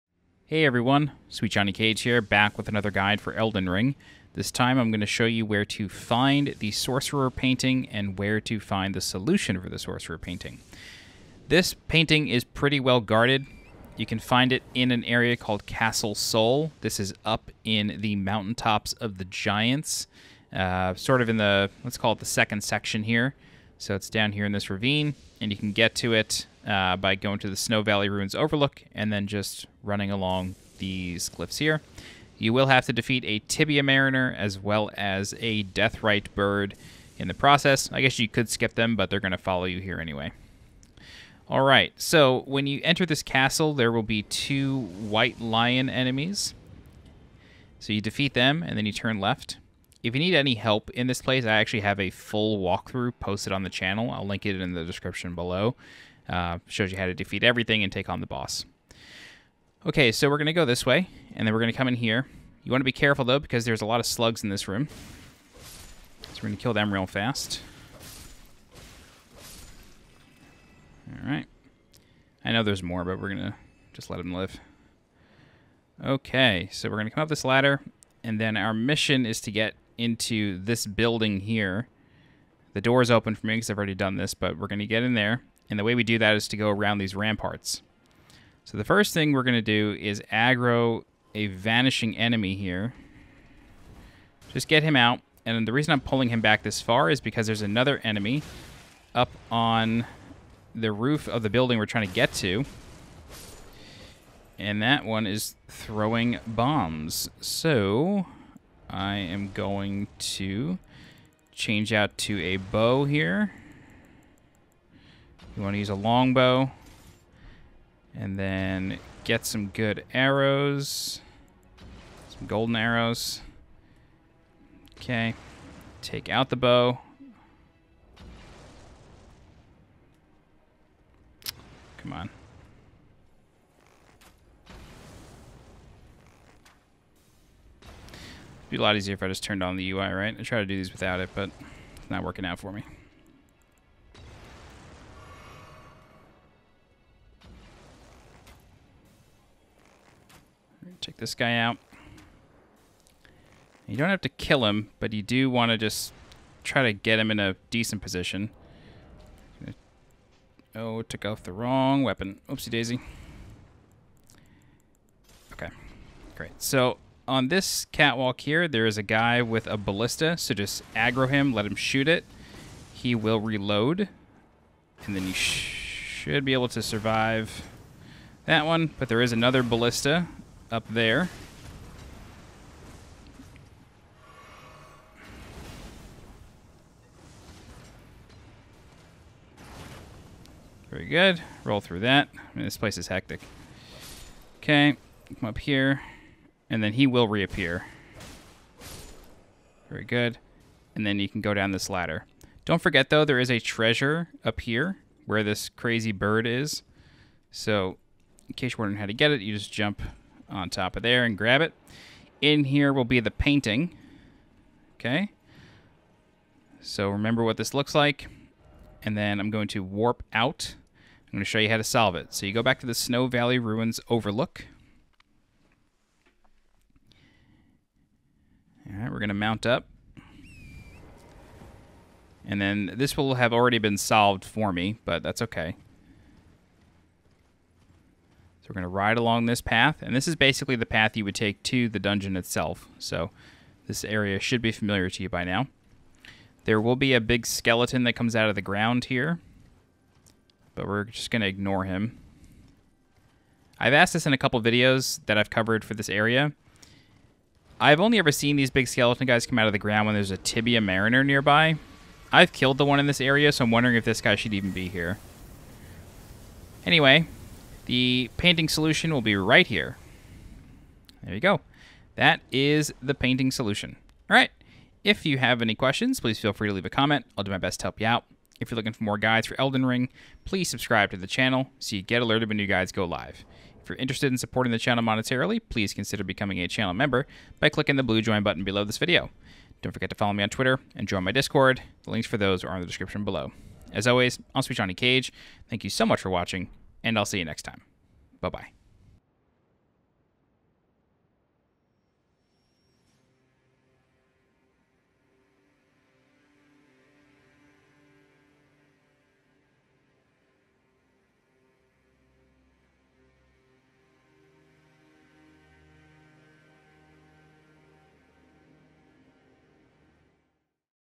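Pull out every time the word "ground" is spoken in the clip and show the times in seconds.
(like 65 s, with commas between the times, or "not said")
248 s, 259 s.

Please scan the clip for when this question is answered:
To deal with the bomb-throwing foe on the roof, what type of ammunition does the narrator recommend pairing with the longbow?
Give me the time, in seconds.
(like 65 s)
122 s.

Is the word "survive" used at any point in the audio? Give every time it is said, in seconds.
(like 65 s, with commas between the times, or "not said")
176 s.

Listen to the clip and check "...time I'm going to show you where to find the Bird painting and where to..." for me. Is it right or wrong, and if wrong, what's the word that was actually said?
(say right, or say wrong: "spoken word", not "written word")
wrong: "Sorcerer", not "Bird".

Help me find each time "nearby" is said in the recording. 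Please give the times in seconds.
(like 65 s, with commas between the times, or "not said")
261 s.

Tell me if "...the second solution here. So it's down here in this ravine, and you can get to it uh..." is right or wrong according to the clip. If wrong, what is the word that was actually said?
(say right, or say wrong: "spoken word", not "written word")
wrong: "section", not "solution".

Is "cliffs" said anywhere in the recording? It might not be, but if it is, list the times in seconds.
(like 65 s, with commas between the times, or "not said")
31 s.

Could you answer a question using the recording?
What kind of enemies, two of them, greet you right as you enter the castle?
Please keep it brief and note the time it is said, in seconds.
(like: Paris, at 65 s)
White lion enemies, at 44 s.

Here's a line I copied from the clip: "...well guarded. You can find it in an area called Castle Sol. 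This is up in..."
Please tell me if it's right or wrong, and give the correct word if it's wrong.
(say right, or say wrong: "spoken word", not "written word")
right.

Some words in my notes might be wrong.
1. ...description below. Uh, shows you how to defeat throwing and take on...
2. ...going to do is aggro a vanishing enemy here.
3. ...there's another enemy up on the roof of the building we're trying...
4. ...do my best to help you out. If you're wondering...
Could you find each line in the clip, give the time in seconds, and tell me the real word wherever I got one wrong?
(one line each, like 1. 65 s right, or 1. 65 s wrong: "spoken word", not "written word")
1. 54 s wrong: "everything", not "throwing"
2. 89 s right
3. 97 s right
4. 277 s wrong: "looking", not "wondering".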